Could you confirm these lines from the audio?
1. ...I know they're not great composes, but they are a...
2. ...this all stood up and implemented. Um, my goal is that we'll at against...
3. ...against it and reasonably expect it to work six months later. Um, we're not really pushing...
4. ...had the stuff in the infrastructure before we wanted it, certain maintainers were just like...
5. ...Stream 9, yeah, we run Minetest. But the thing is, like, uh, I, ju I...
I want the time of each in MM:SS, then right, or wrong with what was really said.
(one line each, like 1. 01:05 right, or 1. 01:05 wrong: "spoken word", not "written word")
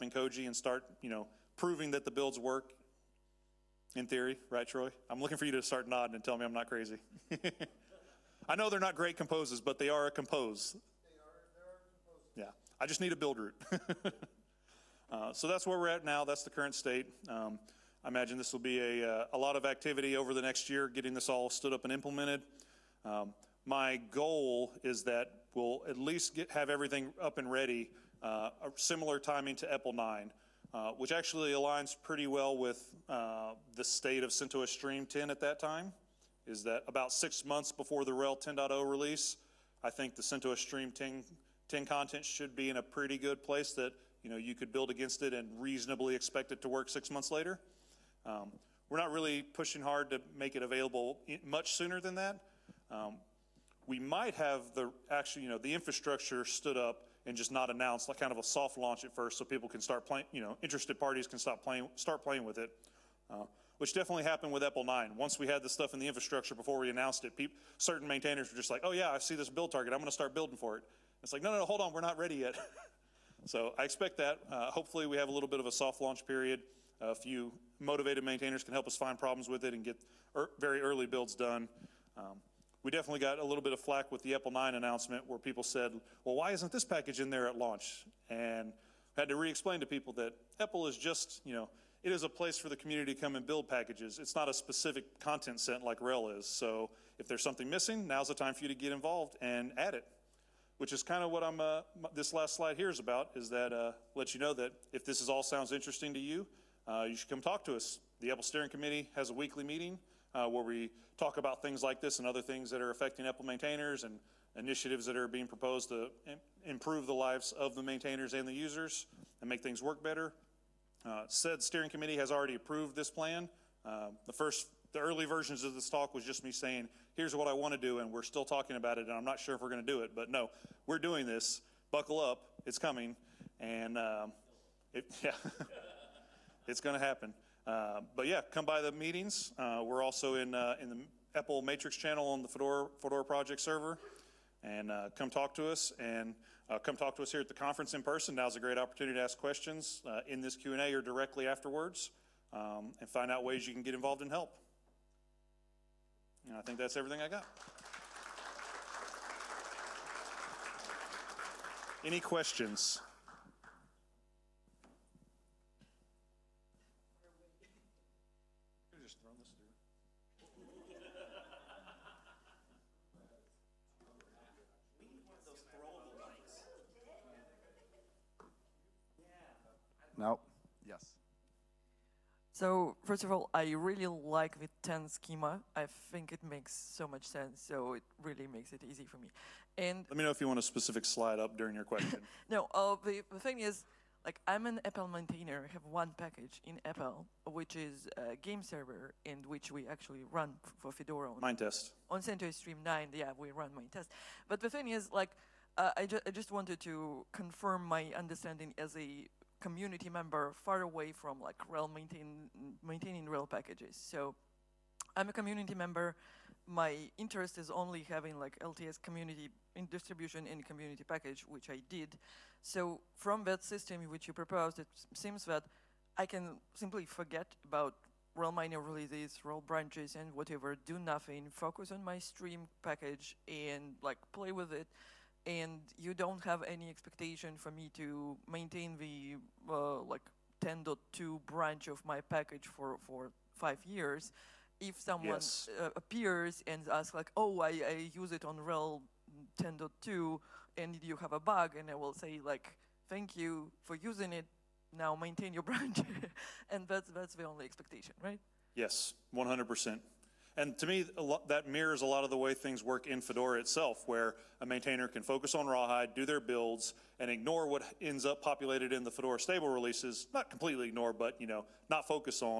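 1. 00:08 right
2. 00:21 wrong: "least", not "against"
3. 00:44 right
4. 01:05 wrong: "announced", not "wanted"
5. 03:22 right.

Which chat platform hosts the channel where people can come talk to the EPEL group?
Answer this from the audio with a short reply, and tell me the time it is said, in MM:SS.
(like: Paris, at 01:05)
Matrix, at 02:21.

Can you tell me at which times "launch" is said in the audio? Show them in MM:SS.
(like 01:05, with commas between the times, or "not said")
00:58, 01:16, 01:27.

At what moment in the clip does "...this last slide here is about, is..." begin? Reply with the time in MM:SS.
01:42.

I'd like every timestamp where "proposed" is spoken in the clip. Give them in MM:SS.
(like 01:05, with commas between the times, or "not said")
01:55, 03:44.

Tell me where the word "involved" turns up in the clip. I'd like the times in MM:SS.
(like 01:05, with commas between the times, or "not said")
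01:38, 02:33.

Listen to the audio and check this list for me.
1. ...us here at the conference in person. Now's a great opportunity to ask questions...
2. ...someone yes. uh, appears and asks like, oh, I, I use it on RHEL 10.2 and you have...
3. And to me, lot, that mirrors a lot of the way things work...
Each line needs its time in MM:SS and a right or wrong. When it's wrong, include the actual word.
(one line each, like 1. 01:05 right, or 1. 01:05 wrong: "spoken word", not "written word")
1. 02:27 right
2. 04:04 right
3. 04:20 right.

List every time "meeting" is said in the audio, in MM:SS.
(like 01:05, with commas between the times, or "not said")
01:49, 02:18.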